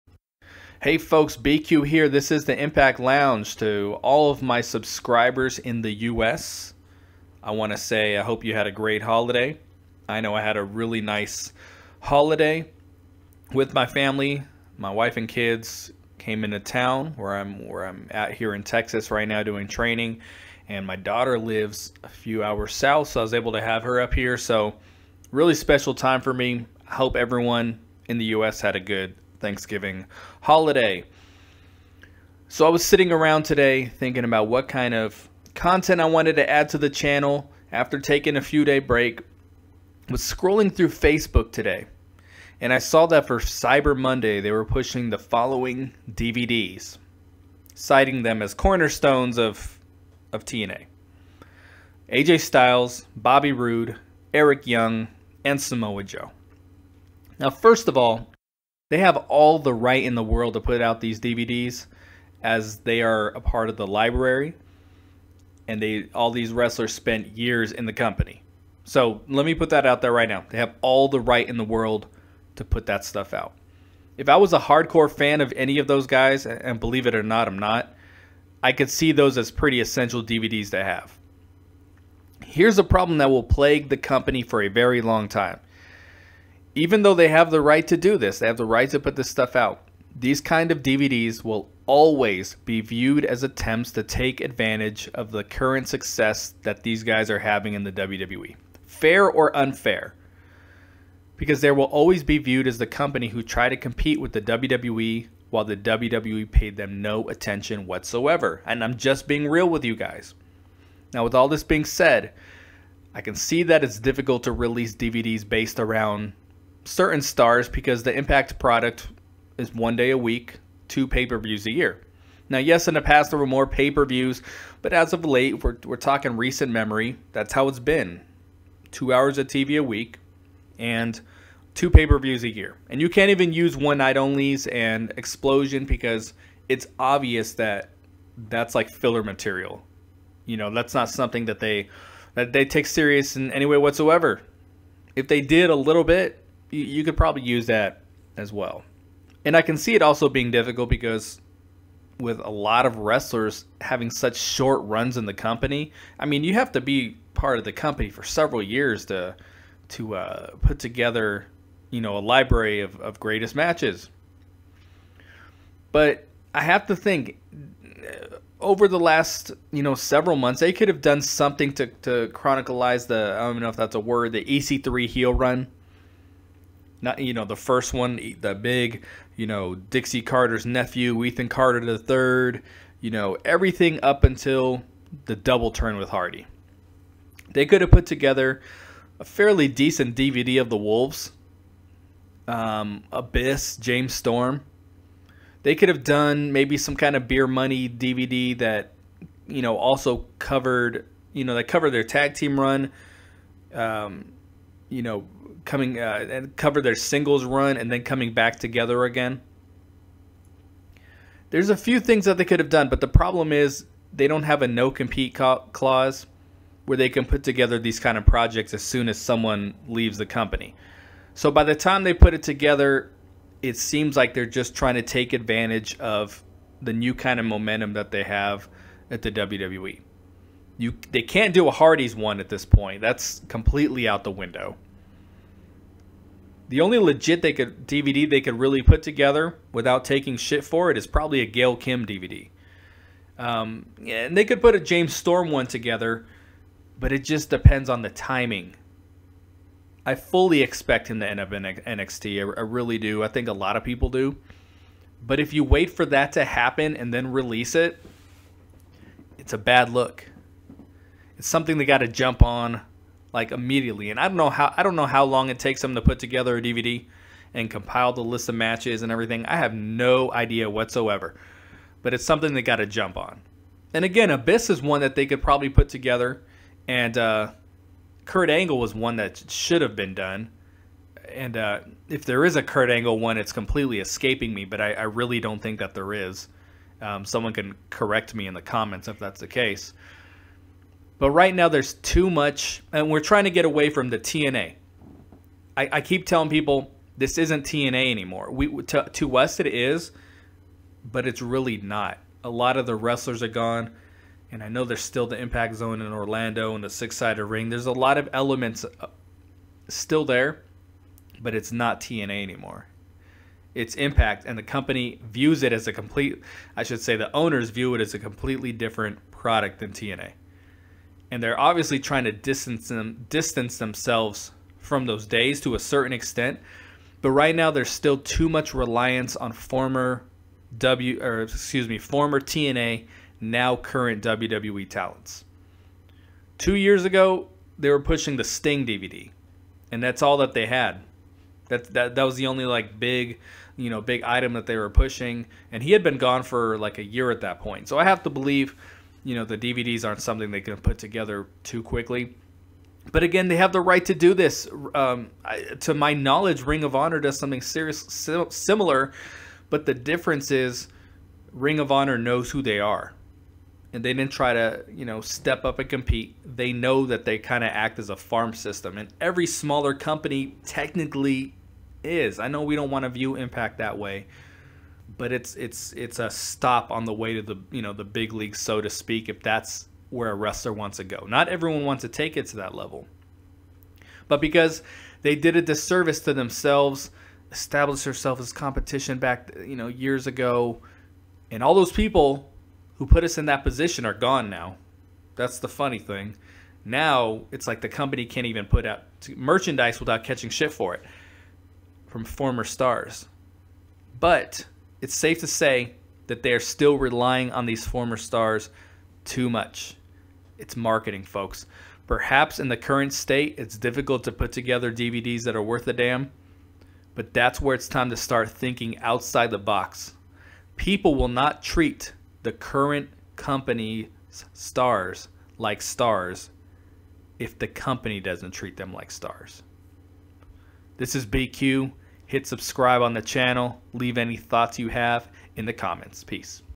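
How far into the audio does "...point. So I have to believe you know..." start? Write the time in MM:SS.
05:47.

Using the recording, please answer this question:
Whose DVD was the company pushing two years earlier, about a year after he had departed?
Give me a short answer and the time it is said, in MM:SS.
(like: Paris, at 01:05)
Sting, at 05:38.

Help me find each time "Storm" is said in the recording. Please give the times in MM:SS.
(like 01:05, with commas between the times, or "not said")
03:14, 04:05.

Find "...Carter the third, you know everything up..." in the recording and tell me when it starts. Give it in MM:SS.
03:01.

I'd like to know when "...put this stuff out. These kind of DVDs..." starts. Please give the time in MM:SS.
01:28.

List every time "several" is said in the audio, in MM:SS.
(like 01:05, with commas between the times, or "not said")
02:38, 02:49.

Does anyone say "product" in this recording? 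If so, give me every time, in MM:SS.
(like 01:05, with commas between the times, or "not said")
01:58, 05:19.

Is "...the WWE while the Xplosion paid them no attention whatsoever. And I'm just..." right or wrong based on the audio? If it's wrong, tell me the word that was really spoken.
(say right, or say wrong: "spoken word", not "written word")
wrong: "WWE", not "Xplosion".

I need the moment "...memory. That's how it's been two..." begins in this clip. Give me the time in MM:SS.
02:06.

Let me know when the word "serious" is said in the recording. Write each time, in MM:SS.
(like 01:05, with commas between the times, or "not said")
02:22, 05:57.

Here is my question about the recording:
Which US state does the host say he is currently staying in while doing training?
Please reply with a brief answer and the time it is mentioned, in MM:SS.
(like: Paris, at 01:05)
Texas, at 00:18.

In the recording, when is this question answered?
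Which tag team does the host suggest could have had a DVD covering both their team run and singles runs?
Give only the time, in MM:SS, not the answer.
03:17.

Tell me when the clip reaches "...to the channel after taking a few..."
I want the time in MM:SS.
00:36.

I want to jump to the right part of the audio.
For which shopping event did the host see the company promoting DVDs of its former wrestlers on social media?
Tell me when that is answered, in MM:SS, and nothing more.
00:43.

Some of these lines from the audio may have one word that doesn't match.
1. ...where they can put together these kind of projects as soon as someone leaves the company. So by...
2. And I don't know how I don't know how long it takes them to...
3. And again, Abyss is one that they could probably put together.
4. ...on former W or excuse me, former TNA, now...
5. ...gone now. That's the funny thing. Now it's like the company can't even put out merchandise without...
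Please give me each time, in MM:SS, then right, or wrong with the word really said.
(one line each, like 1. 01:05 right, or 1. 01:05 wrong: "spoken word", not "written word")
1. 03:36 right
2. 04:24 right
3. 04:33 right
4. 05:29 right
5. 06:34 right.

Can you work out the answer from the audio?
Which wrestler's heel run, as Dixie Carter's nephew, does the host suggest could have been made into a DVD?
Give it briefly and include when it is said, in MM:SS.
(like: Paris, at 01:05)
EC3, at 02:54.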